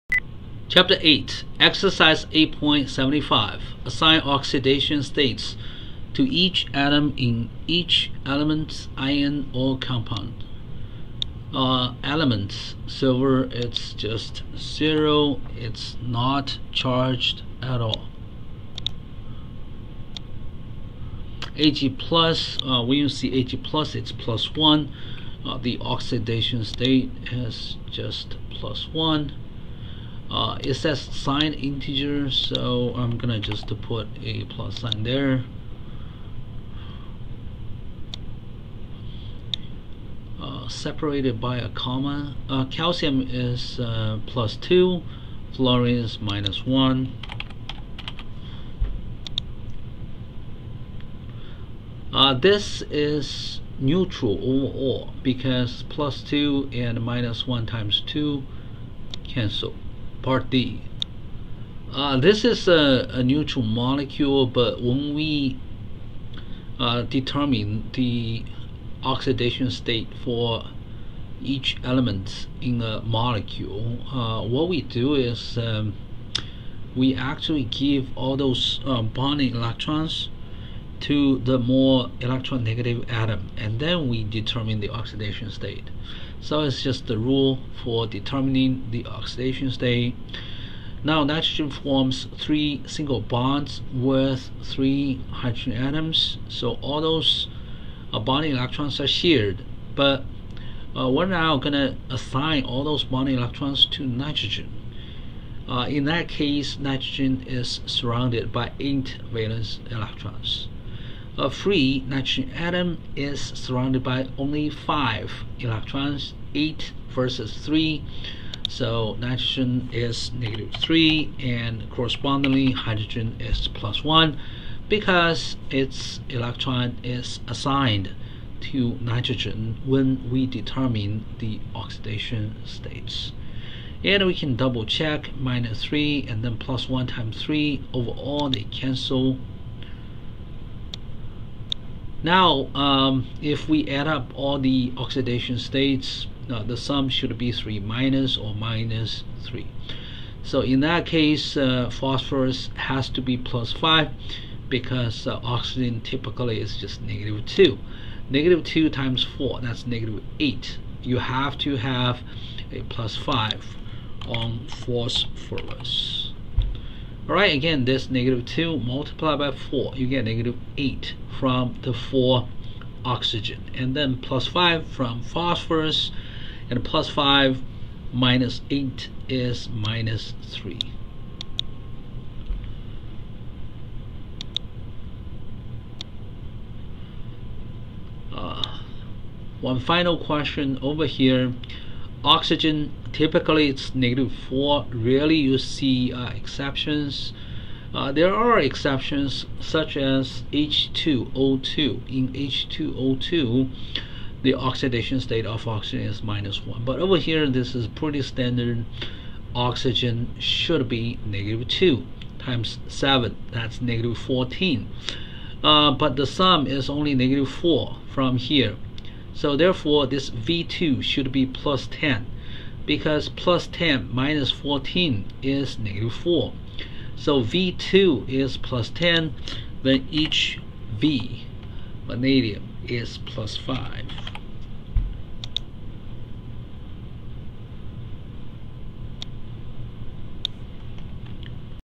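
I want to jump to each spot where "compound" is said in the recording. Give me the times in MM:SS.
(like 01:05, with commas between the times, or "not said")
00:09.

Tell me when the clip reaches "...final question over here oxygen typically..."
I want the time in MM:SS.
03:09.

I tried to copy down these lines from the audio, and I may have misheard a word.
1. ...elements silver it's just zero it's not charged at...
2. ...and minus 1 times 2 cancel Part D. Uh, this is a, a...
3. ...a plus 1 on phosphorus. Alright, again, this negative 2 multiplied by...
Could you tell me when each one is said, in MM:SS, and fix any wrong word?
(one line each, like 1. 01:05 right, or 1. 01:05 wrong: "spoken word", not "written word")
1. 00:12 right
2. 00:56 right
3. 02:42 wrong: "5", not "1".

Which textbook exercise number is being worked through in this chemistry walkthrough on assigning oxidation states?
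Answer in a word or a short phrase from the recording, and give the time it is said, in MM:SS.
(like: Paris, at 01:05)
8.75, at 00:02.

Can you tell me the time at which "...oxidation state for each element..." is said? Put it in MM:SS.
01:09.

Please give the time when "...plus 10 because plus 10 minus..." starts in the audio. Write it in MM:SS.
03:41.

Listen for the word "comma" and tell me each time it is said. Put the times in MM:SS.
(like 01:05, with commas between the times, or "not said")
00:41.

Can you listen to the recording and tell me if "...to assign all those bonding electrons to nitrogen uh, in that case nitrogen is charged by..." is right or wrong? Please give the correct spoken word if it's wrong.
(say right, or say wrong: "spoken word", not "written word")
wrong: "surrounded", not "charged".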